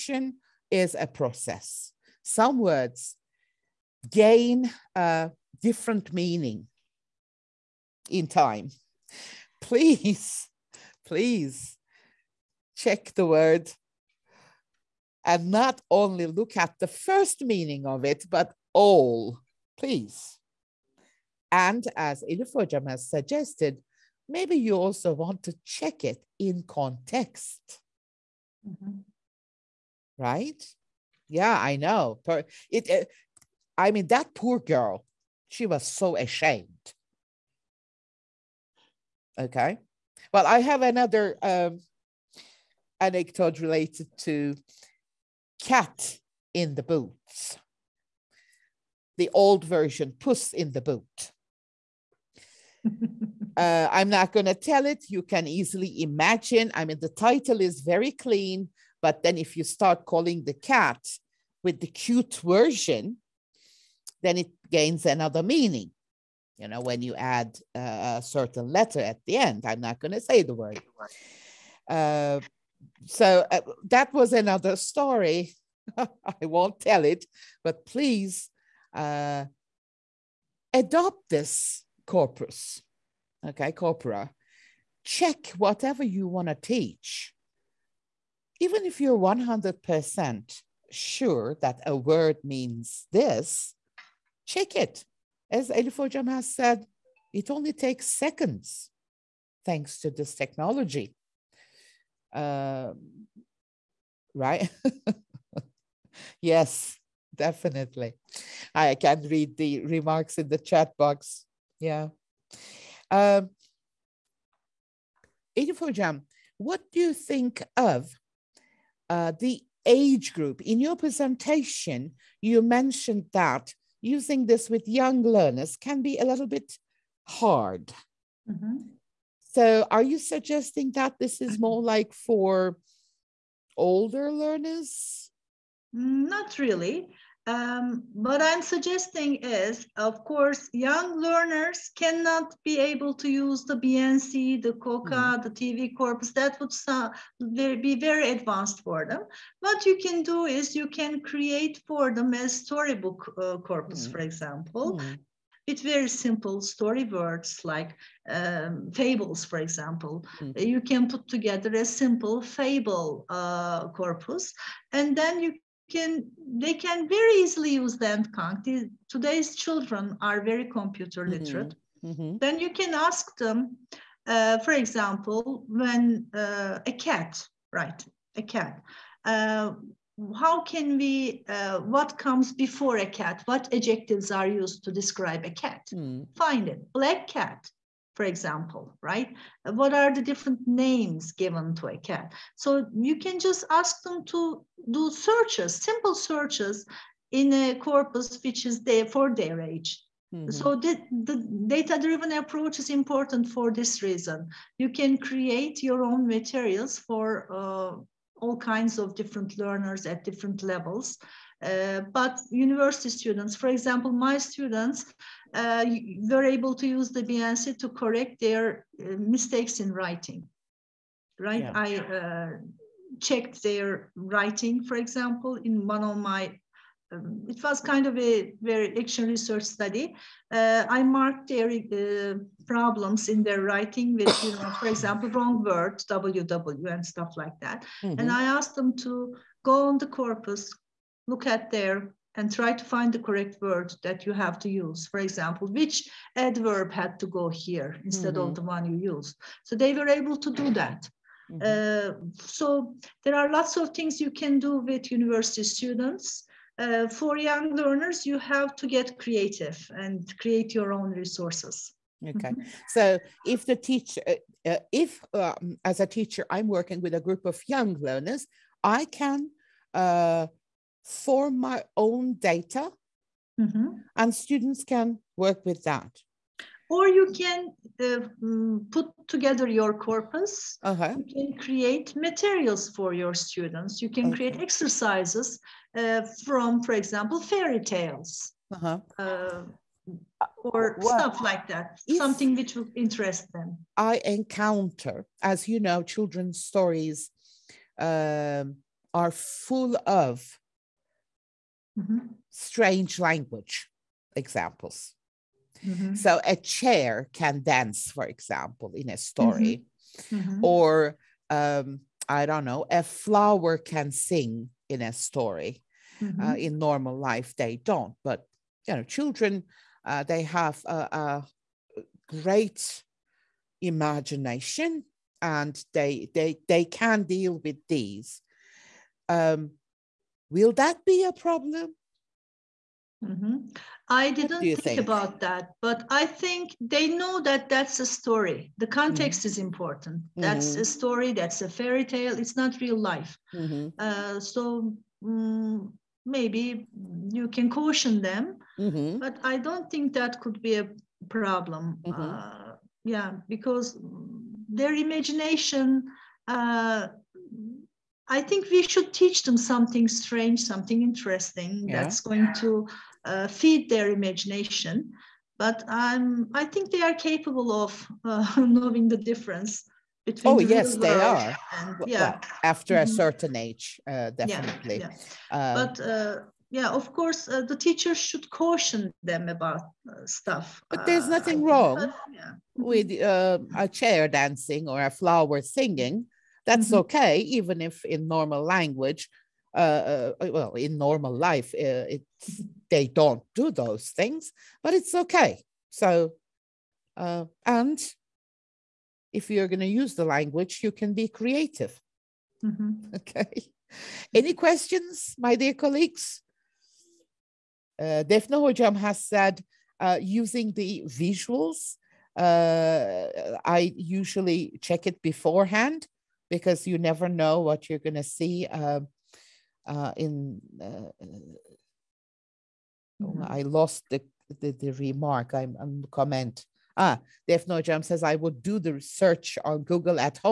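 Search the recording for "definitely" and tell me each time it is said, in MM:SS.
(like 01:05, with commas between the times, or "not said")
01:47, 06:14.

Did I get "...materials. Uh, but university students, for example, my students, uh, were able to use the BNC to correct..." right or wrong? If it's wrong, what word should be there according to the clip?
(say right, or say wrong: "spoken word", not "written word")
wrong: "levels", not "materials".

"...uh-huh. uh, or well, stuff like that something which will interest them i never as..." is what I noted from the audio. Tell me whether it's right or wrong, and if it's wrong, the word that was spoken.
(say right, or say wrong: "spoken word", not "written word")
wrong: "encounter", not "never".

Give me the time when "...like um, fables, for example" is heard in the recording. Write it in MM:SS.
02:37.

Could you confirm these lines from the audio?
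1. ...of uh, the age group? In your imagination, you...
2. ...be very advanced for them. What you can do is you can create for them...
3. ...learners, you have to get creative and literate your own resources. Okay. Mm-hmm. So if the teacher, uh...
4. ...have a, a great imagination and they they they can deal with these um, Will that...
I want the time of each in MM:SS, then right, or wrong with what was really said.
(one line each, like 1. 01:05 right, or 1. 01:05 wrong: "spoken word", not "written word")
1. 01:57 wrong: "presentation", not "imagination"
2. 02:27 right
3. 04:17 wrong: "create", not "literate"
4. 05:20 right.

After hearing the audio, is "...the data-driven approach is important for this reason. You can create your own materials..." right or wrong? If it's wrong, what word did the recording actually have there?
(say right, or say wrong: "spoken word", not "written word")
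right.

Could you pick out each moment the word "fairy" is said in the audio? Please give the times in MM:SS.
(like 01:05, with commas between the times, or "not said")
04:47, 05:41.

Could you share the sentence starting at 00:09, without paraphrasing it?
Please, please check the word and not only look at the first meaning of it, but all, please.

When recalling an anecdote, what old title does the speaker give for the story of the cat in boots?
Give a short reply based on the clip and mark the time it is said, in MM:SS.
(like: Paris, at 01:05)
Puss in the boot, at 00:50.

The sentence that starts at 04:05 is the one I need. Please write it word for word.
For example, which adverb had to go here instead mm-hmm.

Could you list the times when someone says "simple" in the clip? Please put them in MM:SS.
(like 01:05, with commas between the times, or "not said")
02:36, 02:41, 03:15.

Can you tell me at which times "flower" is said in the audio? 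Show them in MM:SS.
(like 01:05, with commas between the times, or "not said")
05:13, 06:25.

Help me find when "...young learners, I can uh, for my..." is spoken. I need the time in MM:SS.
04:27.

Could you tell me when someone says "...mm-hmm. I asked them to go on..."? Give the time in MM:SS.
03:58.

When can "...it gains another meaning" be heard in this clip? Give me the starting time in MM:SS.
01:04.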